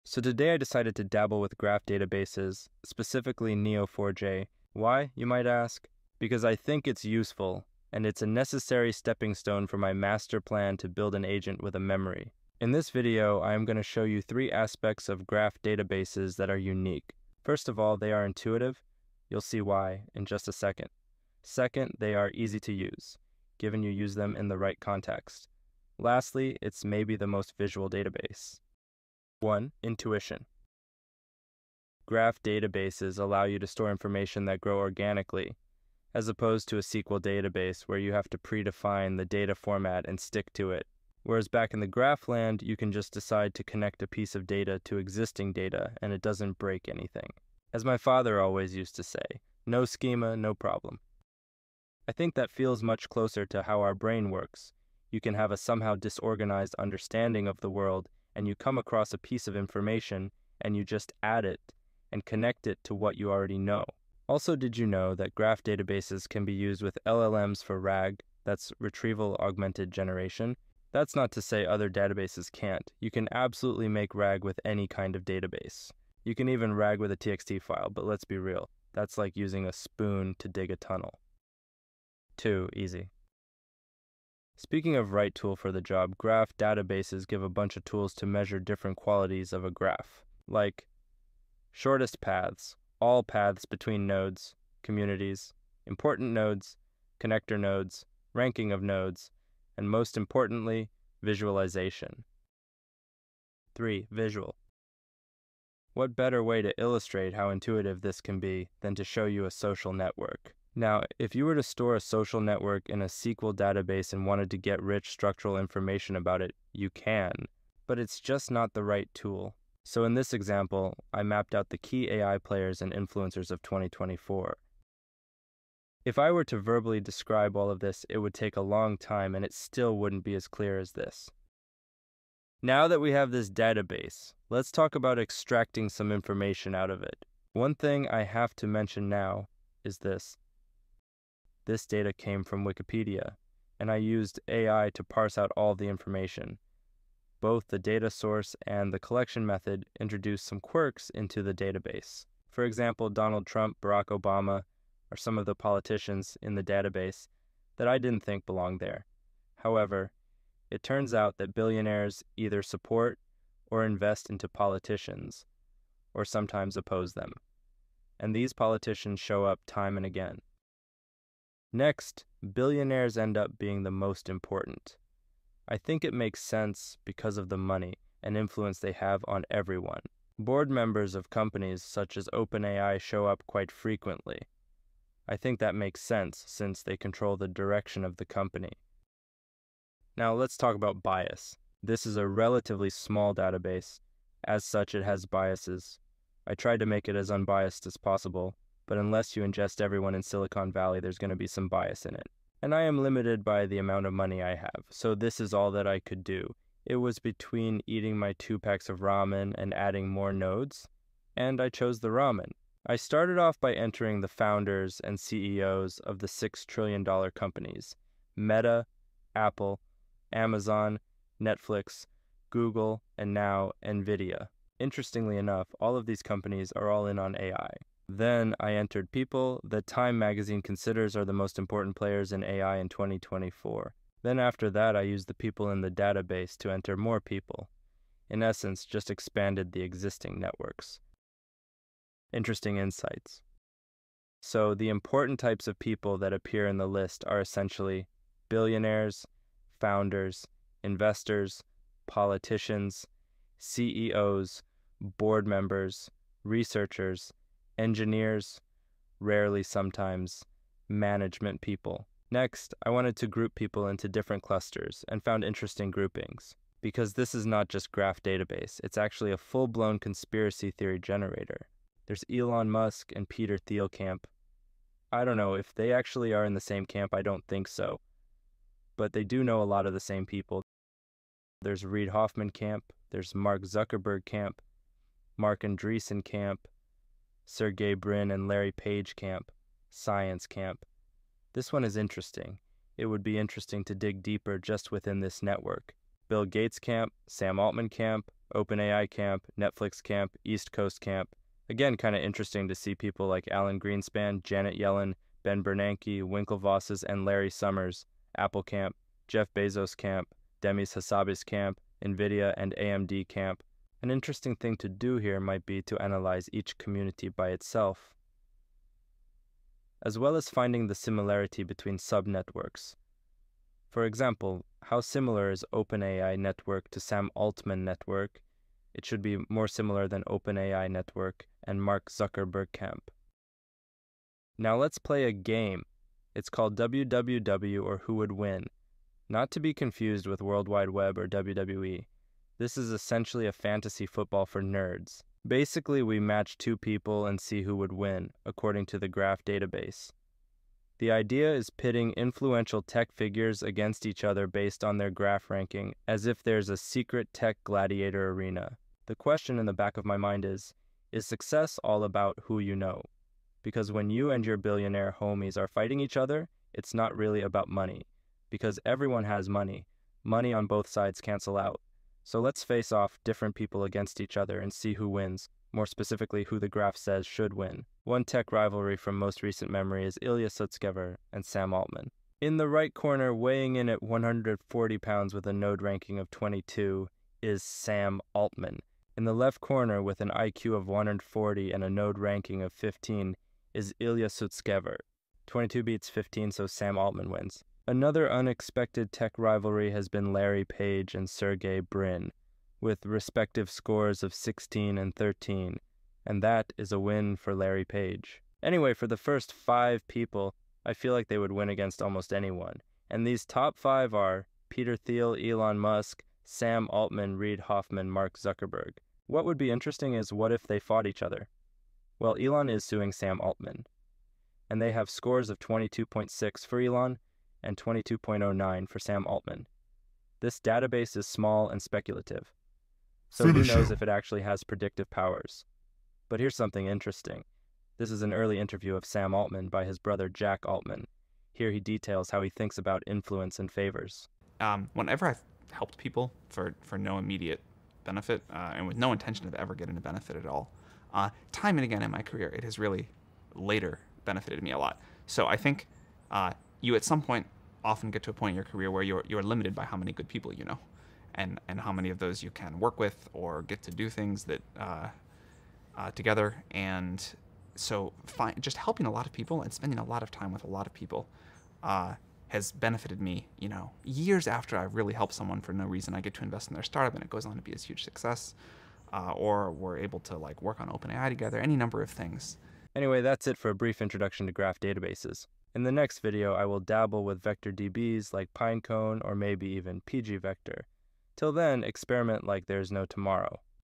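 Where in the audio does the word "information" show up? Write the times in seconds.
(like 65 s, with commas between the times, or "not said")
33 s, 59 s, 115 s, 136 s, 145 s.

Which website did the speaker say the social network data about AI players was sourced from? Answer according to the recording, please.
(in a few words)
Wikipedia.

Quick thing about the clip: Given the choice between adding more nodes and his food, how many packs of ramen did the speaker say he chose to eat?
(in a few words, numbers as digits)
2.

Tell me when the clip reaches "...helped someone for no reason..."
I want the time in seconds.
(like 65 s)
475 s.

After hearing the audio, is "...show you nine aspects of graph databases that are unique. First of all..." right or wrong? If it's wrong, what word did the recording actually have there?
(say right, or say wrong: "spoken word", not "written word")
wrong: "three", not "nine".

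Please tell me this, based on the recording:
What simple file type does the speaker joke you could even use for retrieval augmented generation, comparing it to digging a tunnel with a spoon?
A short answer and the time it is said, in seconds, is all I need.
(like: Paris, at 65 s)
TXT file, at 77 s.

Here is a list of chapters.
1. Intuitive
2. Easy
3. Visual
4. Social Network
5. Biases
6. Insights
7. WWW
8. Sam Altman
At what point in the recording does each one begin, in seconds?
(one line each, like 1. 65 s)
1. 30 s
2. 81 s
3. 120 s
4. 132 s
5. 189 s
6. 241 s
7. 333 s
8. 433 s.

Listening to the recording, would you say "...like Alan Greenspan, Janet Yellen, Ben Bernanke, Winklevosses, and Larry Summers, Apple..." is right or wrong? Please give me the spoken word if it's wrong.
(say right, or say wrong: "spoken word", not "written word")
right.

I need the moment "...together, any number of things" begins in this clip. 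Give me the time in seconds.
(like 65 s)
481 s.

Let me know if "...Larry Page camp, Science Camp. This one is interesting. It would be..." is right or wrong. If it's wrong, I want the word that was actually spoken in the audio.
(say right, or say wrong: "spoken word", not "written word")
right.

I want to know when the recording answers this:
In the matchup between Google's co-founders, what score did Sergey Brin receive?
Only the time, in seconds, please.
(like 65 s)
405 s.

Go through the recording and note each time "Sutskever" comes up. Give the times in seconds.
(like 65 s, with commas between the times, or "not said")
380 s, 394 s.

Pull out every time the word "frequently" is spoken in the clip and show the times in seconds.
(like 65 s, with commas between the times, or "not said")
183 s.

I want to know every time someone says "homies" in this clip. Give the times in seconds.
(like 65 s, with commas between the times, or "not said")
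365 s.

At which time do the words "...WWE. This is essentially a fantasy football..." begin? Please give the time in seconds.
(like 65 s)
341 s.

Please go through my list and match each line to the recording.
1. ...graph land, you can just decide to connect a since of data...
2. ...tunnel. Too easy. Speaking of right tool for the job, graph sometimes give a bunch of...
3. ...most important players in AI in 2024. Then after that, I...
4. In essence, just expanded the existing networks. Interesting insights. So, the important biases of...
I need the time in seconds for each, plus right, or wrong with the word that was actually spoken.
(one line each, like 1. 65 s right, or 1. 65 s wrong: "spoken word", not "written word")
1. 41 s wrong: "piece", not "since"
2. 80 s wrong: "databases", not "sometimes"
3. 231 s right
4. 238 s wrong: "types", not "biases".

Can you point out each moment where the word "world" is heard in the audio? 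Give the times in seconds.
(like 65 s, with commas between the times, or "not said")
57 s, 340 s.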